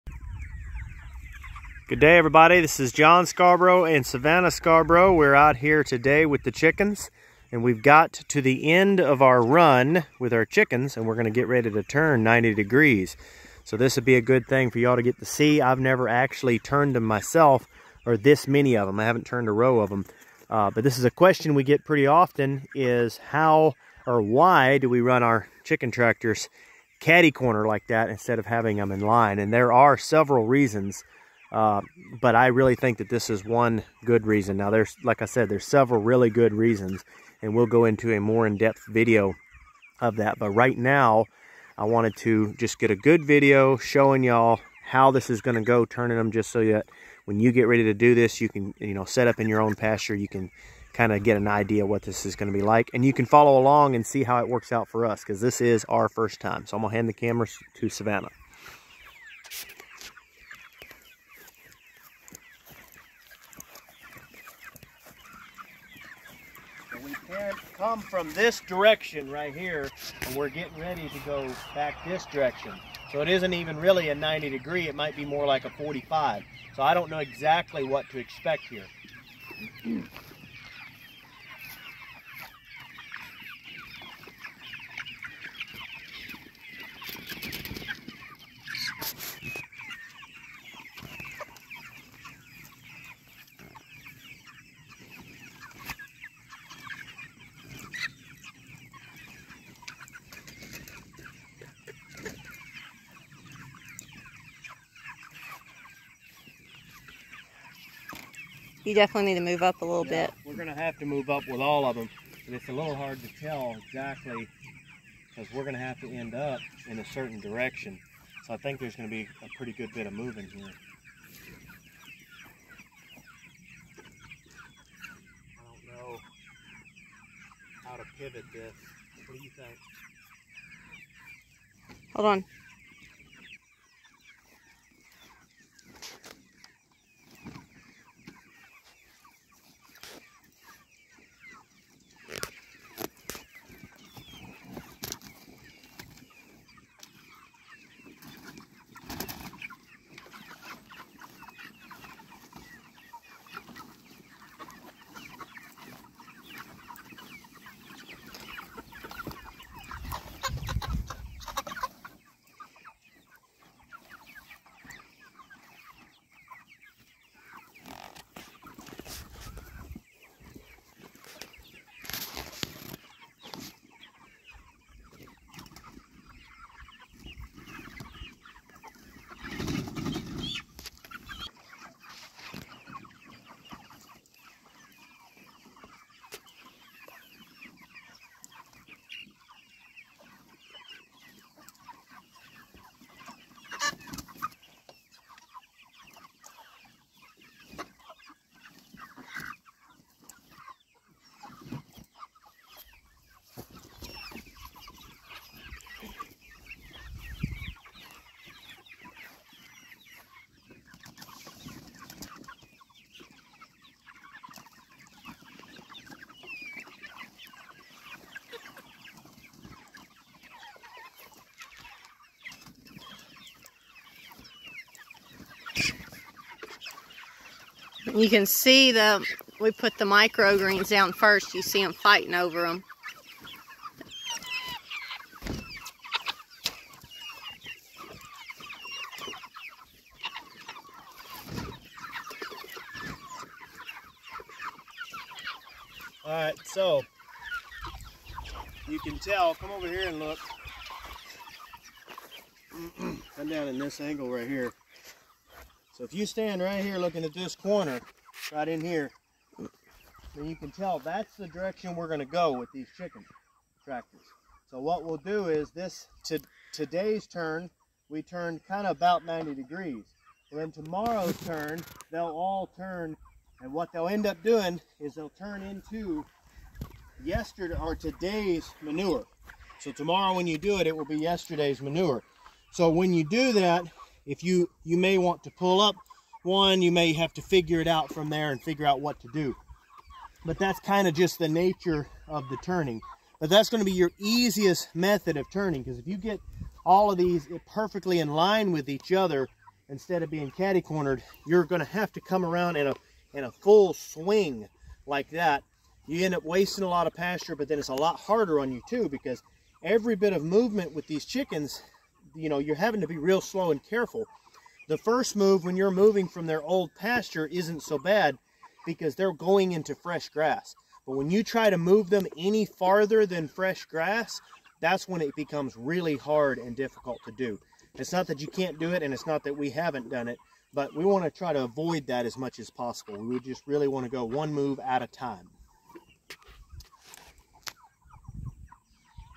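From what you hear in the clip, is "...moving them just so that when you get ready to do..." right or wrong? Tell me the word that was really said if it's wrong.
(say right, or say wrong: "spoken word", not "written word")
wrong: "turning", not "moving".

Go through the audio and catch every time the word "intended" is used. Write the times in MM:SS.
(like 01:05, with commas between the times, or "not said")
not said.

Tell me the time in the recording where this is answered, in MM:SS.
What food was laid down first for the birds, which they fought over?
03:50.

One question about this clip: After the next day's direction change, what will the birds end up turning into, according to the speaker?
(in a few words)
Yesterday's manure.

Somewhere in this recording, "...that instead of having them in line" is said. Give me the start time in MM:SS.
00:27.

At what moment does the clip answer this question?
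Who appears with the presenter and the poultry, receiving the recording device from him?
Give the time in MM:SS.
00:04.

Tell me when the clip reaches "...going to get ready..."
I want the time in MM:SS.
00:11.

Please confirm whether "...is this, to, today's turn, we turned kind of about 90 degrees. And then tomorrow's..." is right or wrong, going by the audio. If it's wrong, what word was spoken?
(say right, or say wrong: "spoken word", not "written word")
right.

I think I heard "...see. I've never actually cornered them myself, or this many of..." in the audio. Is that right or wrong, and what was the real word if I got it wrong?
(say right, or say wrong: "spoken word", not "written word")
wrong: "turned", not "cornered".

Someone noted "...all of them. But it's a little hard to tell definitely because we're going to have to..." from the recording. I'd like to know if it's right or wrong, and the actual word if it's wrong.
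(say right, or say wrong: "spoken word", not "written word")
wrong: "exactly", not "definitely".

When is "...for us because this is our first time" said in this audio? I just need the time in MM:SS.
00:54.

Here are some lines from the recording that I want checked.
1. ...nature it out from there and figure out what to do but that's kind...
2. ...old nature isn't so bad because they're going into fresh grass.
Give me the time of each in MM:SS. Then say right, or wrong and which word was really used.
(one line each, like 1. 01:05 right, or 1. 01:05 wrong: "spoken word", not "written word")
1. 04:47 wrong: "figure", not "nature"
2. 05:16 wrong: "pasture", not "nature".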